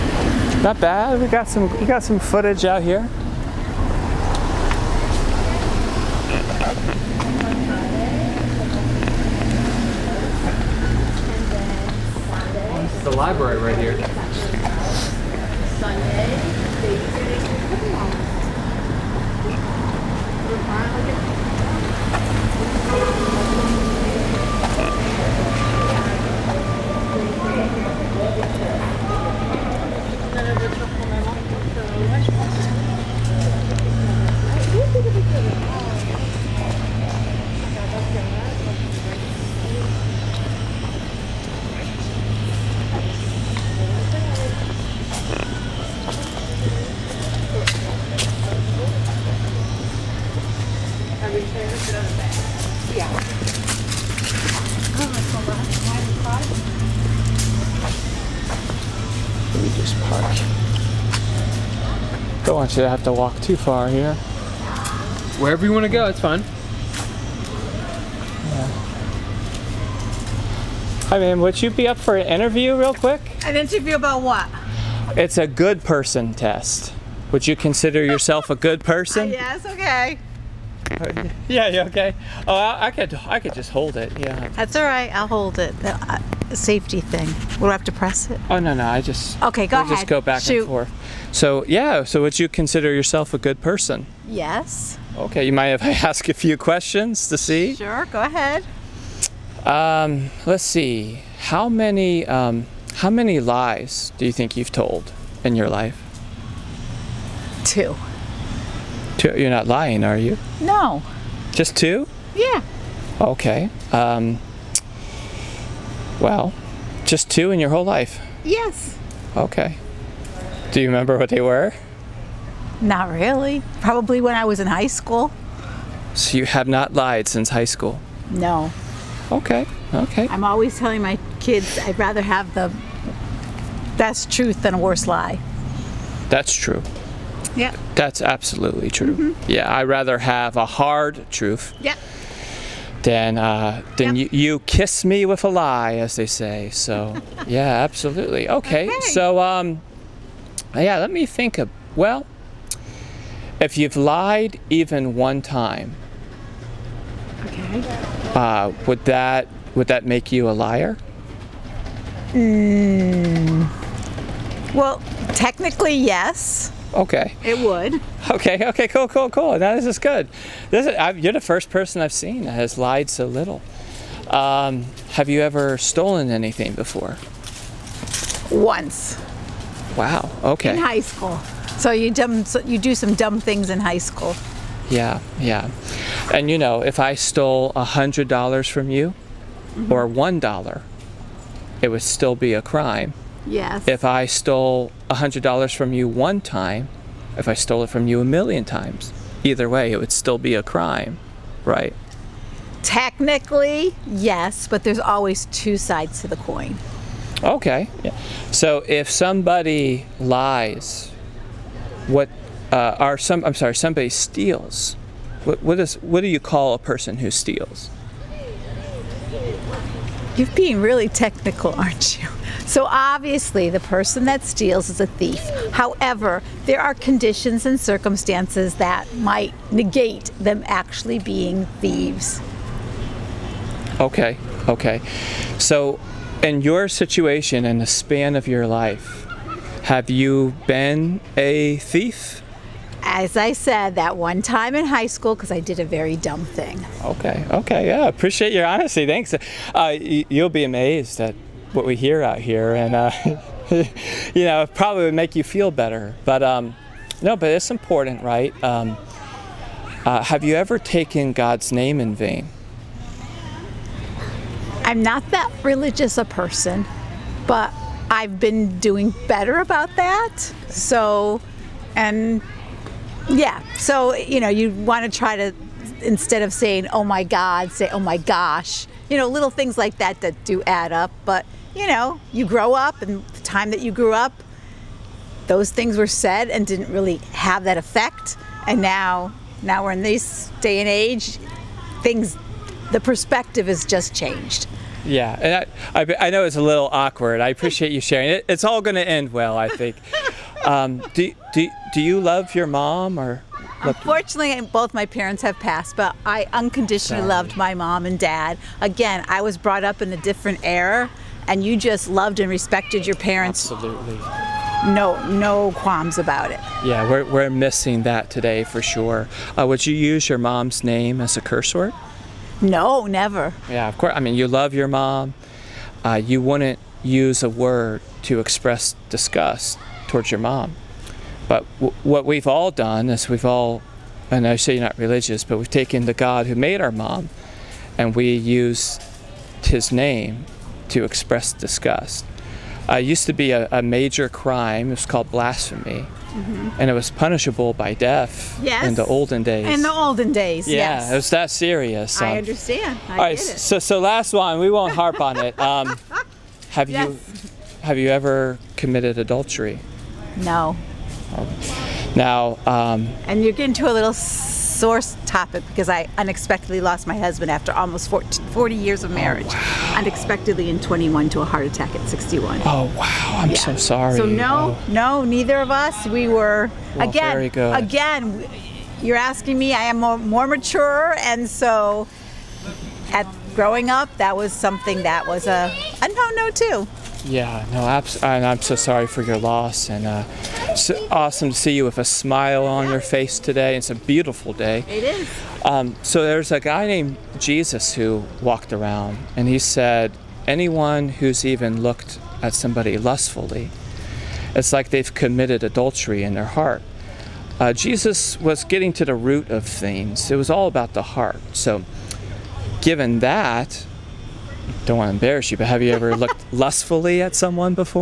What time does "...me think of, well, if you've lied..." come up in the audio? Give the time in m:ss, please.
2:31.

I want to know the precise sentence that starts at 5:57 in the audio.
you have you ever committed adultery?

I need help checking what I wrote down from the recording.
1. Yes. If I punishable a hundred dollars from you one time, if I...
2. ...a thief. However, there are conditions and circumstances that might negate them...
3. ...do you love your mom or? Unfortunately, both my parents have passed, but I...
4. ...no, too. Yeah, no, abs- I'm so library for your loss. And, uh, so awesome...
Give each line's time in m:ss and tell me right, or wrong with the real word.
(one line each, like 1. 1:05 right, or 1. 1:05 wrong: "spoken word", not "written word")
1. 3:13 wrong: "stole", not "punishable"
2. 3:44 right
3. 5:01 right
4. 6:26 wrong: "sorry", not "library".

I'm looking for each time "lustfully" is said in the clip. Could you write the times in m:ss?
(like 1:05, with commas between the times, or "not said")
6:42, 6:56.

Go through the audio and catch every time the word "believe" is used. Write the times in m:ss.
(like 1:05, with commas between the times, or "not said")
not said.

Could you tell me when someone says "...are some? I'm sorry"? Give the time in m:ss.
3:32.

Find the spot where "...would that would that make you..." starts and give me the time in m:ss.
2:38.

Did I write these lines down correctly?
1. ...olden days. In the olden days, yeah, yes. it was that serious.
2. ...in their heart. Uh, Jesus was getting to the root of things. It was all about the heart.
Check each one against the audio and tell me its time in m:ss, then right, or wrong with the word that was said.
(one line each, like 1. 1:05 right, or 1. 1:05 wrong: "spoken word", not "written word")
1. 5:49 right
2. 6:46 right.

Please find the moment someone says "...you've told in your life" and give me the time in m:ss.
1:44.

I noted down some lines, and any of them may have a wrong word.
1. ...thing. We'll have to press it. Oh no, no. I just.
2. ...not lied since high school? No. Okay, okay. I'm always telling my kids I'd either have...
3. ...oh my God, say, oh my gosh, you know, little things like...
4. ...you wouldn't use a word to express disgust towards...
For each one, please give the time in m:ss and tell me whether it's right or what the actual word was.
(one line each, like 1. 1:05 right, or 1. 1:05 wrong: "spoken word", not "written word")
1. 1:26 right
2. 2:06 wrong: "rather", not "either"
3. 4:36 right
4. 5:26 right.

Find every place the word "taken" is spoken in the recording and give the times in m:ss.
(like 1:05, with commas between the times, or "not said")
4:20, 5:35.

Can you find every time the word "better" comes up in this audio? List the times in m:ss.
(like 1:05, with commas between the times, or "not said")
4:15, 4:29.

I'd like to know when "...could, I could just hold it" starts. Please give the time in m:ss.
1:22.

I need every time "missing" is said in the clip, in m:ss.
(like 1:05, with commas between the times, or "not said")
5:17.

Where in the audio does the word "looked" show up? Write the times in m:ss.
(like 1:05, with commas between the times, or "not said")
6:41, 6:56.